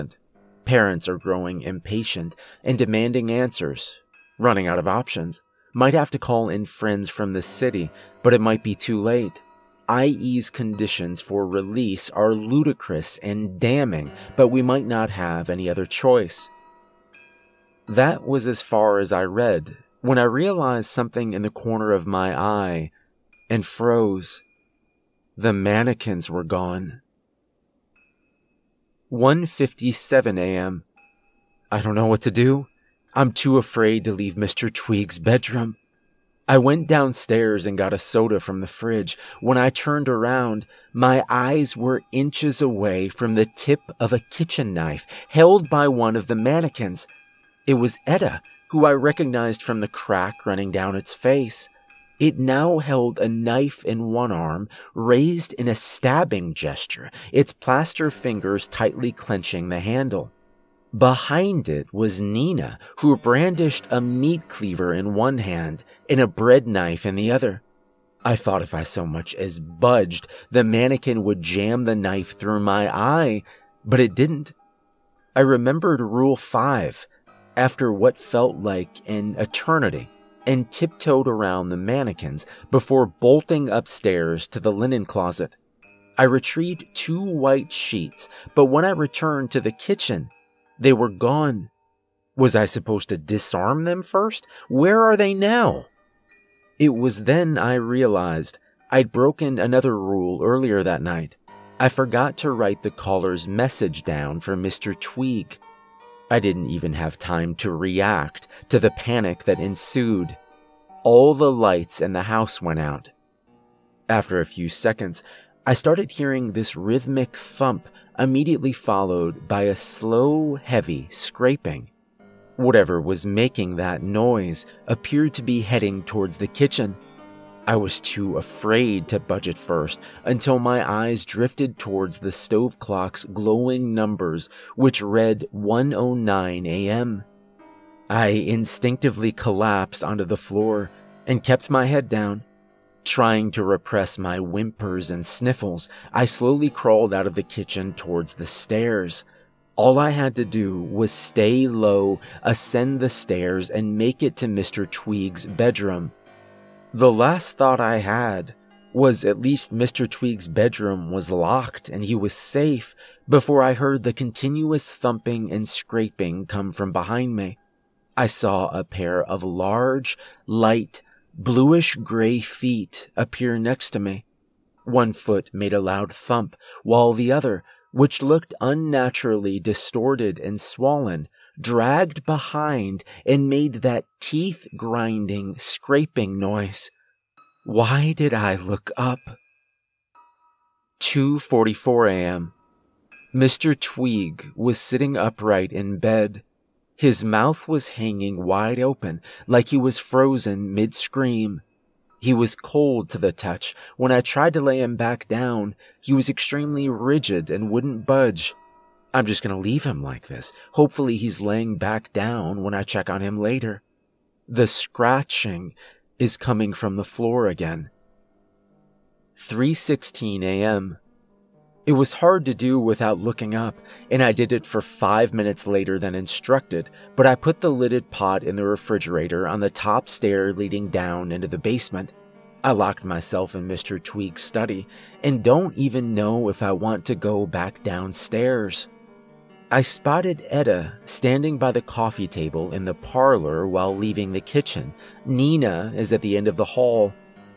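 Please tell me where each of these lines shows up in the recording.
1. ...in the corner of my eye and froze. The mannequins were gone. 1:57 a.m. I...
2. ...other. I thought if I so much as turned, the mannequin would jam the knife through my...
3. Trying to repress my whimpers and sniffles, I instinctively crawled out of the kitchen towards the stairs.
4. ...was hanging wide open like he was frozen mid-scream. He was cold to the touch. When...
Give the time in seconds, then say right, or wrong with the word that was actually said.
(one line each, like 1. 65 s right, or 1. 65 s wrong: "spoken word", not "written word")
1. 21 s right
2. 67 s wrong: "budged", not "turned"
3. 143 s wrong: "slowly", not "instinctively"
4. 197 s right.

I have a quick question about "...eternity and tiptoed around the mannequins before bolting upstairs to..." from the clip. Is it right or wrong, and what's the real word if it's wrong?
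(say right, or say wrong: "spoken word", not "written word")
right.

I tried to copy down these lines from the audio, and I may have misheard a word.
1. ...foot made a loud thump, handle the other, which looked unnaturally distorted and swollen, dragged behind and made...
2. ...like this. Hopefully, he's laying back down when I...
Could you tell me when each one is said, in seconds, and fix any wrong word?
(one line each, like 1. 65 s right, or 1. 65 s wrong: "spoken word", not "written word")
1. 175 s wrong: "while", not "handle"
2. 210 s right.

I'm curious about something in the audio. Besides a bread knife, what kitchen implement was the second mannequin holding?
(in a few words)
meat cleaver.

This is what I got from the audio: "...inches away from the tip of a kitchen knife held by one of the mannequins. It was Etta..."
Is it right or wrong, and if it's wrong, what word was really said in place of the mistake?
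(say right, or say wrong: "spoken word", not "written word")
right.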